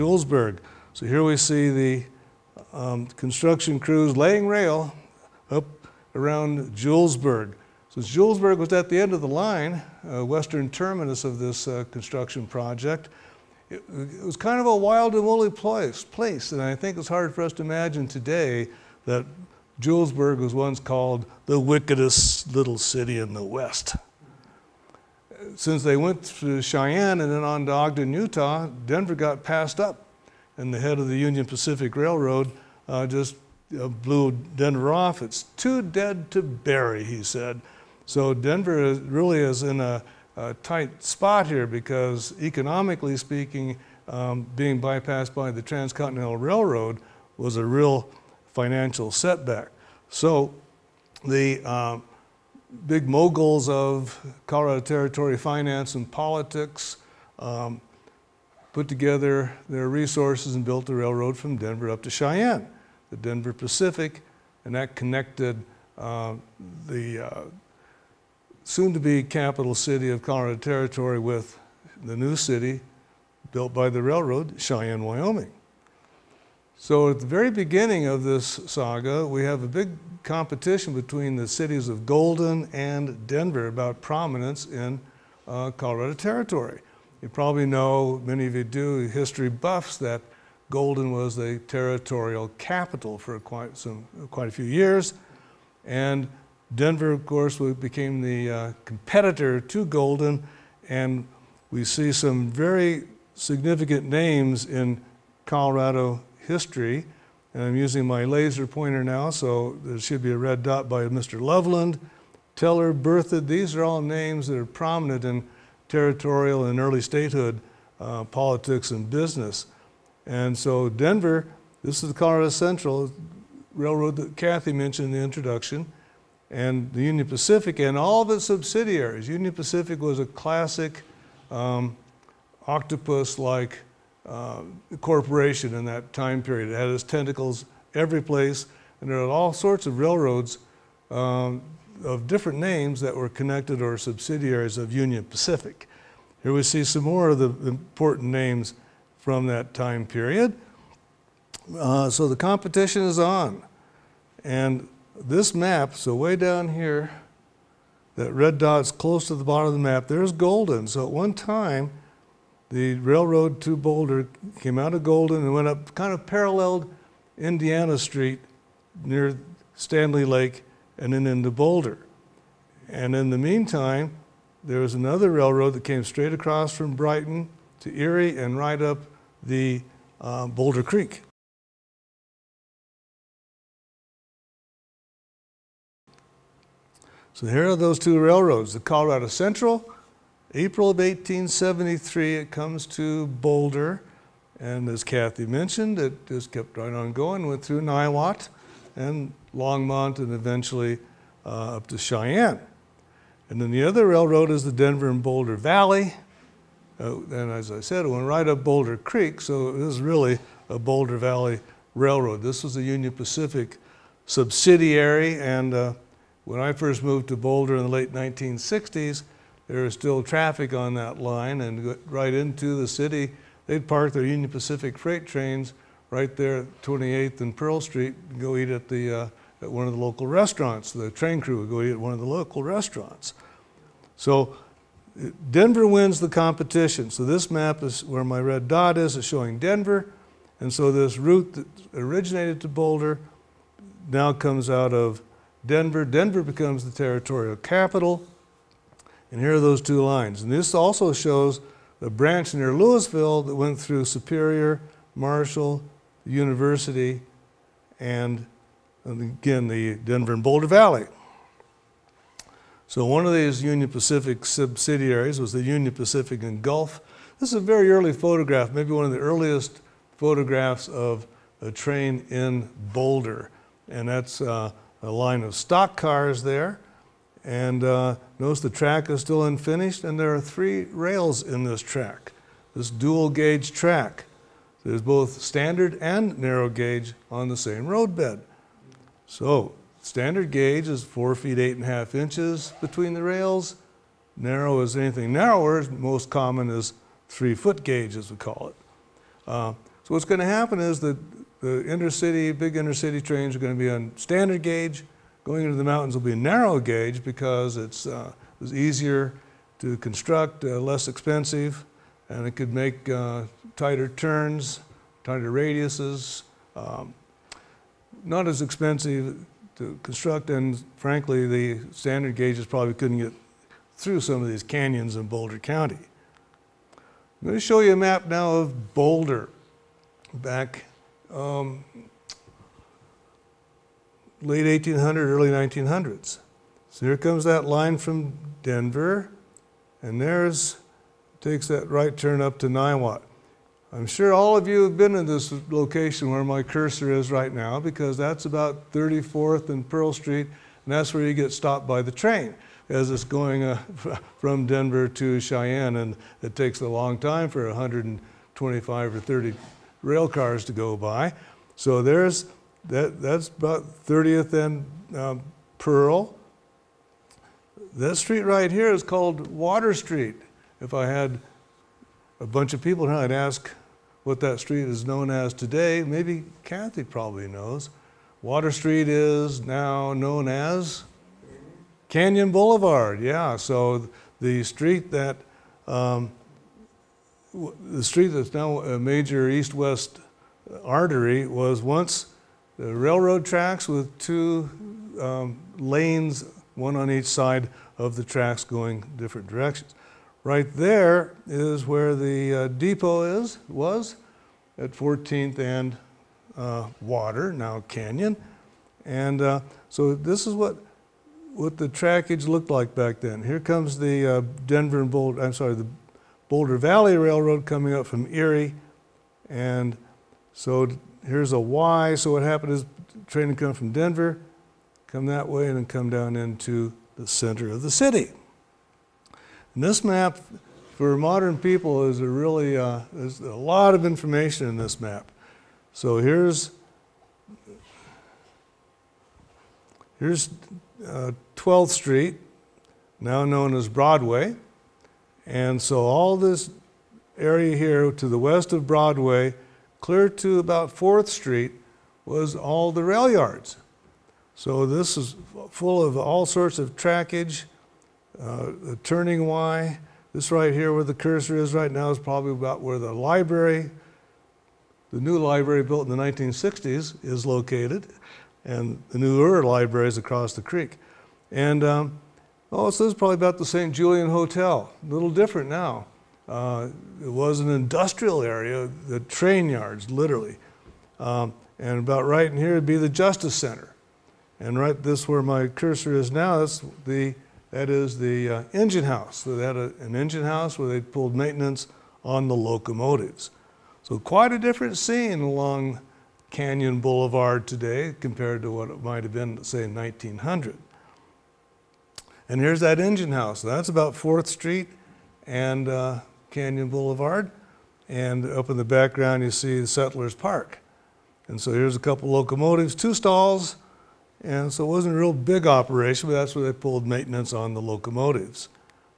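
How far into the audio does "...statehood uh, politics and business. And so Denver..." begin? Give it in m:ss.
1:57.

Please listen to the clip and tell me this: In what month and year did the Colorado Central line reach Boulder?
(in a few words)
April 1873.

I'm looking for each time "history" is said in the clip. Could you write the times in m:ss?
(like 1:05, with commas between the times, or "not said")
1:29, 1:46.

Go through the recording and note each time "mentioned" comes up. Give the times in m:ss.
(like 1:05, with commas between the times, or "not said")
2:04, 3:15.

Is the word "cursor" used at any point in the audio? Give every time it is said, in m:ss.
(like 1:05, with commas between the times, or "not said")
5:46, 7:41, 8:05.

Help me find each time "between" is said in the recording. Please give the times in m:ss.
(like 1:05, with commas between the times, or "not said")
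1:20, 4:52.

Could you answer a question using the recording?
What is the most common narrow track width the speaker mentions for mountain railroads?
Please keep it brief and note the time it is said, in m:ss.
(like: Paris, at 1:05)
3 foot gauge, at 4:57.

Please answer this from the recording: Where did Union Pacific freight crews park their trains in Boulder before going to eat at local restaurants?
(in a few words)
28th and Pearl Street.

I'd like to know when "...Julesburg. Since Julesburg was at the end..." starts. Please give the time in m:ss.
0:06.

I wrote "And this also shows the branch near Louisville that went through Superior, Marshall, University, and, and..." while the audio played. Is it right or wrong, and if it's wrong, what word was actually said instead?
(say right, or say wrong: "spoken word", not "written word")
right.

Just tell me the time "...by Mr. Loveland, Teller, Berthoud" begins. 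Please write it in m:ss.
1:50.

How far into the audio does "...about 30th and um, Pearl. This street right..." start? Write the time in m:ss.
6:03.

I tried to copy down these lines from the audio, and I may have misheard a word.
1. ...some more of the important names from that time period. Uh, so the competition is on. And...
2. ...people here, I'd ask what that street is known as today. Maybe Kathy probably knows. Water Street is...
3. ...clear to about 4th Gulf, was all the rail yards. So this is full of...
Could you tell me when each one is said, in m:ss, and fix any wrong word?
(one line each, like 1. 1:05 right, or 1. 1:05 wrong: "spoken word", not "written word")
1. 2:26 right
2. 6:12 right
3. 7:29 wrong: "Street", not "Gulf".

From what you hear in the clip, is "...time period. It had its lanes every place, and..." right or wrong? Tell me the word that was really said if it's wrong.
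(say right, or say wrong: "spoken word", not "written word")
wrong: "tentacles", not "lanes".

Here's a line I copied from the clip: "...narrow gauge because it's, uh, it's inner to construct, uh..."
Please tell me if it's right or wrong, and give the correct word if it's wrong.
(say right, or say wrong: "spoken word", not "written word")
wrong: "easier", not "inner".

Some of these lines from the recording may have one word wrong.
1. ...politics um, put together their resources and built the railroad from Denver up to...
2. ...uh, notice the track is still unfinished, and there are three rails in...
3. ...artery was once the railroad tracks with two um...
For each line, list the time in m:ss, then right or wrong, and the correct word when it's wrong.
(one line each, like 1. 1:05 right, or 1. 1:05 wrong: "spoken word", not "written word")
1. 0:56 right
2. 4:37 right
3. 6:30 right.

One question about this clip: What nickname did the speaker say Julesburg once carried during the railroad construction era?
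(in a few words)
the wickedest little city in the West.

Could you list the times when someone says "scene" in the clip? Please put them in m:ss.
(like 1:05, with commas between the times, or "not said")
8:14.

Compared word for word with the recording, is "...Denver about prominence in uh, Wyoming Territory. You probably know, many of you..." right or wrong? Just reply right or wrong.
wrong.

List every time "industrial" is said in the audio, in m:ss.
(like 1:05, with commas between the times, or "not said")
7:57.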